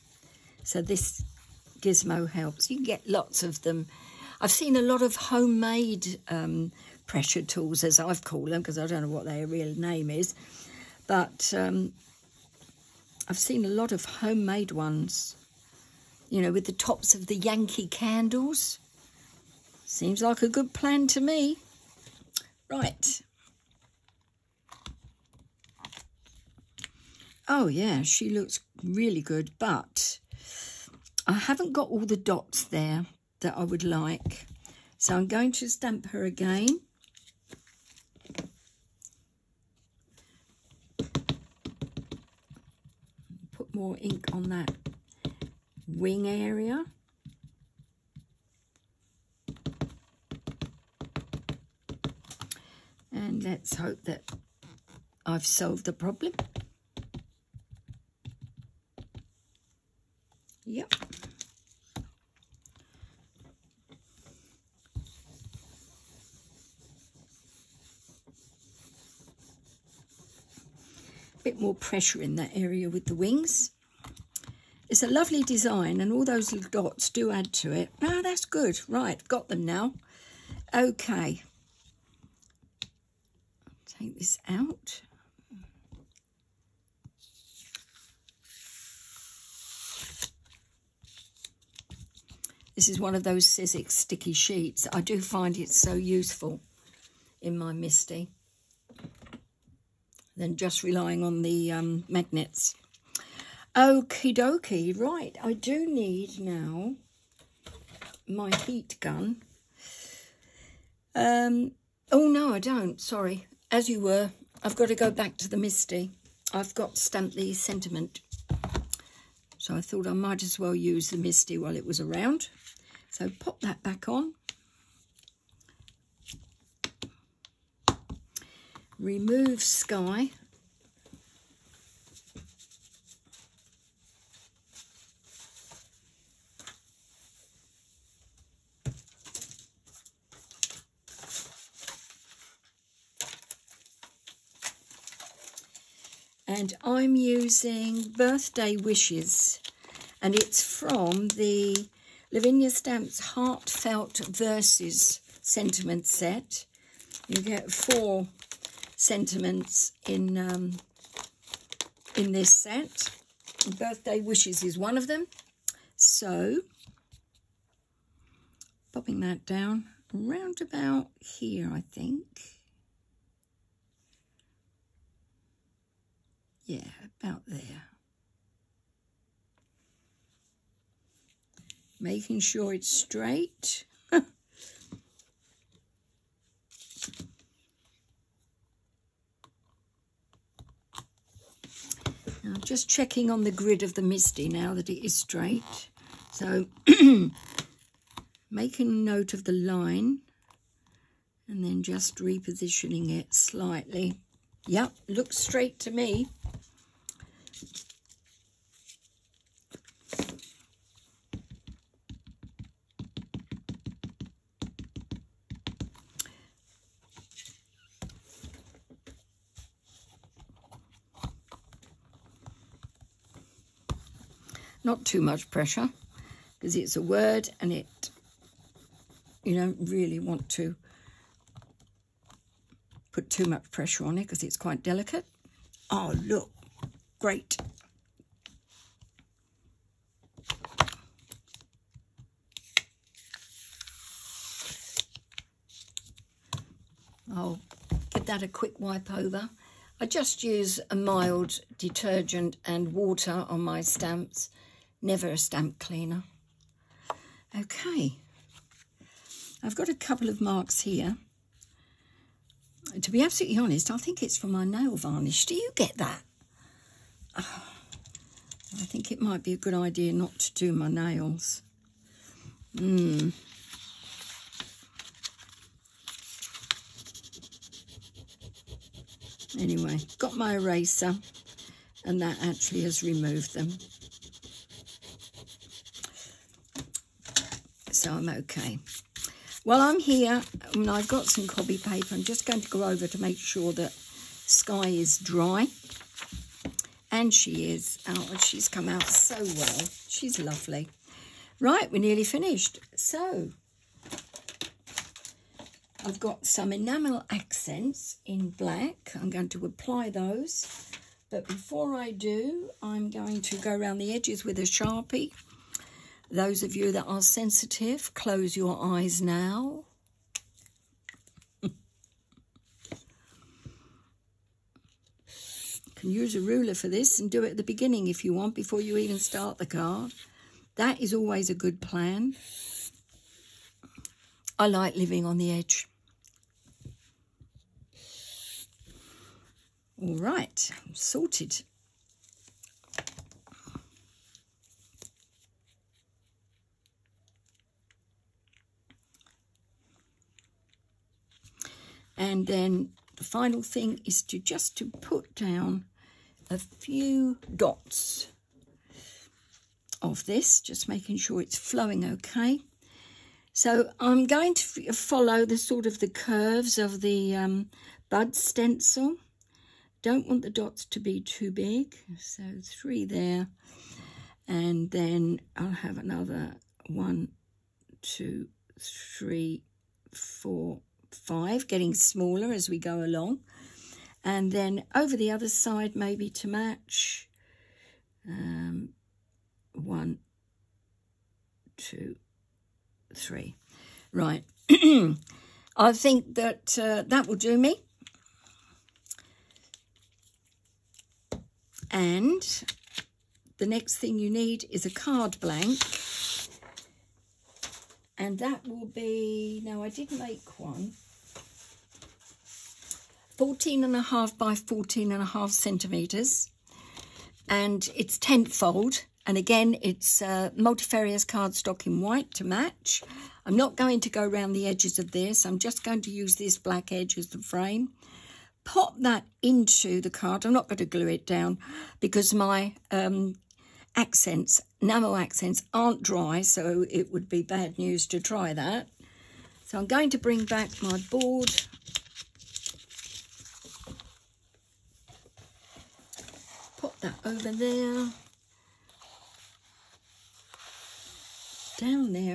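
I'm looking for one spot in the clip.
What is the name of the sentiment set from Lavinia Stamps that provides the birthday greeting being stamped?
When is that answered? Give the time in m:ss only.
2:33.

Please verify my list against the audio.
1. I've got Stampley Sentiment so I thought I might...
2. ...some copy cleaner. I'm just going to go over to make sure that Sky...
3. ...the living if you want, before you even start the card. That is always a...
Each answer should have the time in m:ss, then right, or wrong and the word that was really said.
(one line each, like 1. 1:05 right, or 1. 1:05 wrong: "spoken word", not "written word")
1. 1:56 right
2. 4:51 wrong: "paper", not "cleaner"
3. 5:27 wrong: "beginning", not "living".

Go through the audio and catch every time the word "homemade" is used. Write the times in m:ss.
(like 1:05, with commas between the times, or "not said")
0:05, 0:14.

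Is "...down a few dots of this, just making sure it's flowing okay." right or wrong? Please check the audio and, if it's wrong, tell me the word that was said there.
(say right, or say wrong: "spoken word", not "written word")
right.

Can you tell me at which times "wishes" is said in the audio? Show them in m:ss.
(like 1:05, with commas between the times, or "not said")
2:28, 2:44.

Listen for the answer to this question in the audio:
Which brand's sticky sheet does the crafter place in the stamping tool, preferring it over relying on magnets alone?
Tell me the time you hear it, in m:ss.
1:33.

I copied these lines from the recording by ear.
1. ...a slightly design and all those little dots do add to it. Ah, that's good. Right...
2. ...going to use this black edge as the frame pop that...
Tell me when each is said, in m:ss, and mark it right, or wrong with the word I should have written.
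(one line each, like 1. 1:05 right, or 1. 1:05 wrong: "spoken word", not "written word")
1. 1:15 wrong: "lovely", not "slightly"
2. 7:05 right.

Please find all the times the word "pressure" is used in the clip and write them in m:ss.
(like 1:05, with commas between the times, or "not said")
0:07, 1:11, 3:45, 3:53.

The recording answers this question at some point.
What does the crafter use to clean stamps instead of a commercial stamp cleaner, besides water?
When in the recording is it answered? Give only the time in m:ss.
4:10.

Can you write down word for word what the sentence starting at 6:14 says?
And then I'll have another one, two, three, four, five, getting smaller as we go along.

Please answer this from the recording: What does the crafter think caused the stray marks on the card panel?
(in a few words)
nail varnish.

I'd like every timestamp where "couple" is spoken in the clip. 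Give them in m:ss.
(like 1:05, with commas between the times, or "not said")
4:19.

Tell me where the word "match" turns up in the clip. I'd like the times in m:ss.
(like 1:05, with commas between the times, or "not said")
6:26, 7:02.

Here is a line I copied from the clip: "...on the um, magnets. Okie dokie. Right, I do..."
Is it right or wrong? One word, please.
right.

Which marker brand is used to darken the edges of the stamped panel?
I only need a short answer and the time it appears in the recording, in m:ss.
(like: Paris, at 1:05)
Sharpie, at 5:14.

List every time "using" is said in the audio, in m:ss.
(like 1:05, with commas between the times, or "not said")
2:27.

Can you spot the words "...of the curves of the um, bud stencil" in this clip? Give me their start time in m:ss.
6:05.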